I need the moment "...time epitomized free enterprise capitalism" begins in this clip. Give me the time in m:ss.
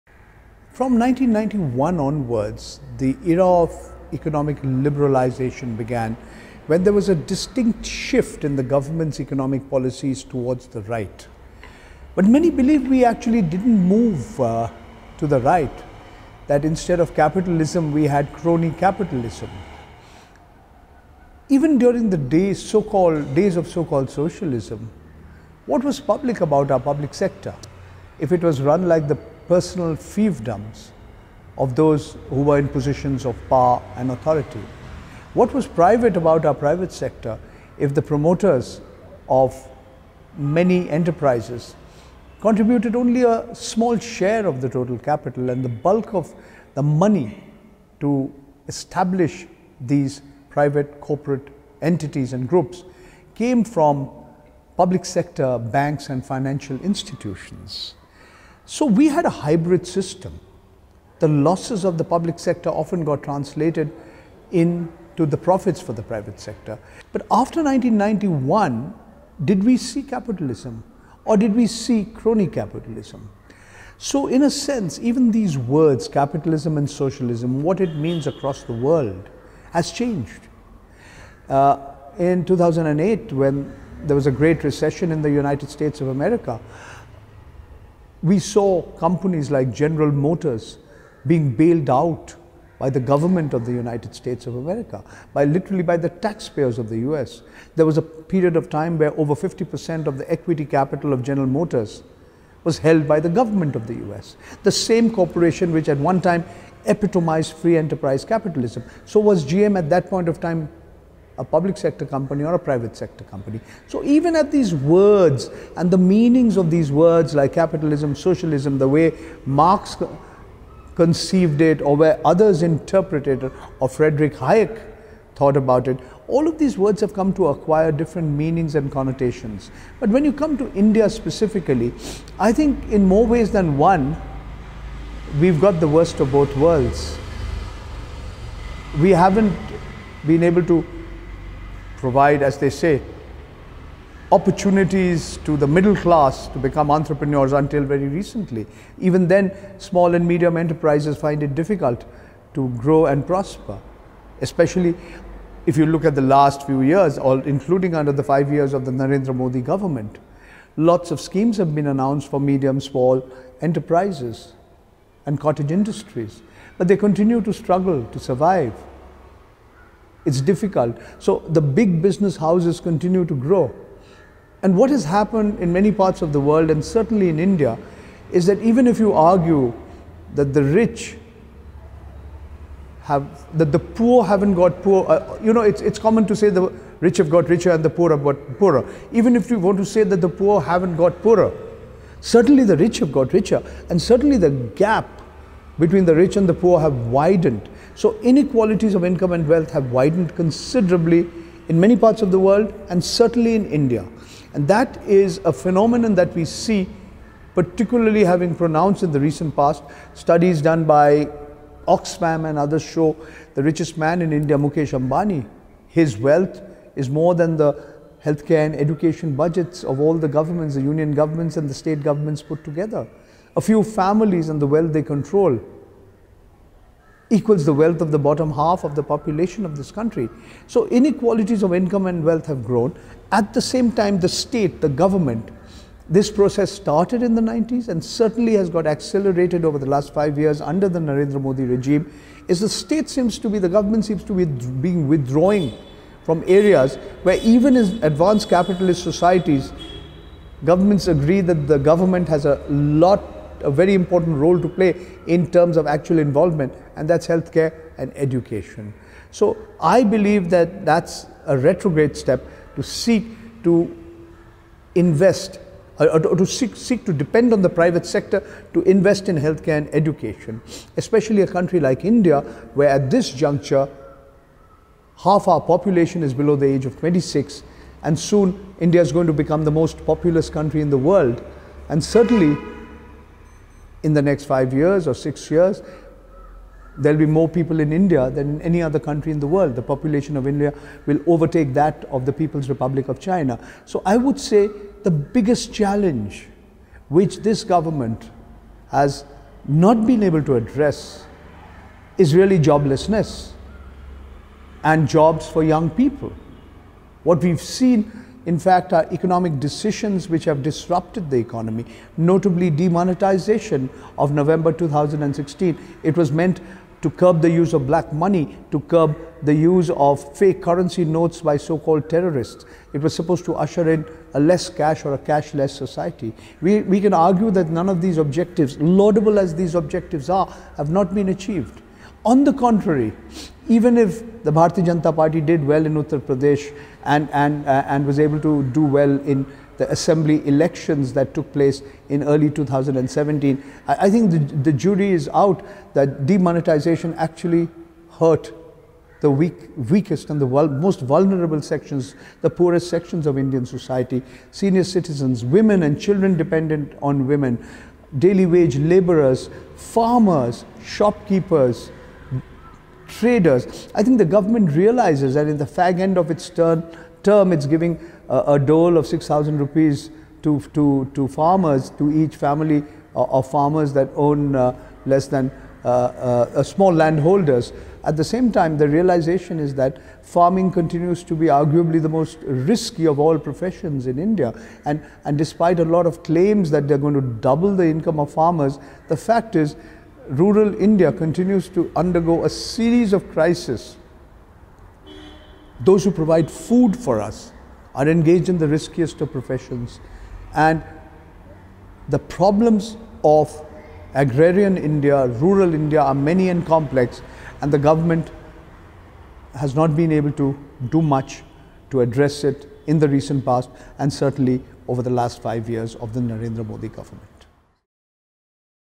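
1:46.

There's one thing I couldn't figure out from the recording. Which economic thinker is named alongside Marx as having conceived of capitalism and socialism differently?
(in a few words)
Frederick Hayek.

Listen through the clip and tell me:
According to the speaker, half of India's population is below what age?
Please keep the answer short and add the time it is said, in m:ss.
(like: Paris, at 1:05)
26, at 4:36.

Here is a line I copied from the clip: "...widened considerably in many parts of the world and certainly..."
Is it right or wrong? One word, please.
right.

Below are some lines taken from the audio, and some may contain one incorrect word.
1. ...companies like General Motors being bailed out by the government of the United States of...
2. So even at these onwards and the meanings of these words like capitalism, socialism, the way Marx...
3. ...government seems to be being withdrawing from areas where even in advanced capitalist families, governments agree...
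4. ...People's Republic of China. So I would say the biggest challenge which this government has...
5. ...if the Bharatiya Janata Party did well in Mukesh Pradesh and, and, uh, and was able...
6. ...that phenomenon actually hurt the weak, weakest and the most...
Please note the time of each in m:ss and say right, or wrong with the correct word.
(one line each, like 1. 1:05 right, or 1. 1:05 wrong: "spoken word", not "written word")
1. 1:28 right
2. 1:53 wrong: "words", not "onwards"
3. 4:03 wrong: "societies", not "families"
4. 4:52 right
5. 5:33 wrong: "Uttar", not "Mukesh"
6. 5:45 wrong: "demonetization", not "phenomenon".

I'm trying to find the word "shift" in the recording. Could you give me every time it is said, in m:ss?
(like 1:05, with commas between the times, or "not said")
0:07.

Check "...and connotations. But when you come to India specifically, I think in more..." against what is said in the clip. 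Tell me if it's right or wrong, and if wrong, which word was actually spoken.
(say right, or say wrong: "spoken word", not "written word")
right.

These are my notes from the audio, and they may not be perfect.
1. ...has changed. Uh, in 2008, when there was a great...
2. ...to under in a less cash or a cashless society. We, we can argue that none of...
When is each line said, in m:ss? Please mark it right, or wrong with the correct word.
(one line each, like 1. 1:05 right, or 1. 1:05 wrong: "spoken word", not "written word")
1. 1:19 right
2. 5:23 wrong: "usher", not "under".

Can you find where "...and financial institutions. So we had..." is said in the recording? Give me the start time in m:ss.
0:56.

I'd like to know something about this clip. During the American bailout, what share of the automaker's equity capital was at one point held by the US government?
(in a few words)
over 50%.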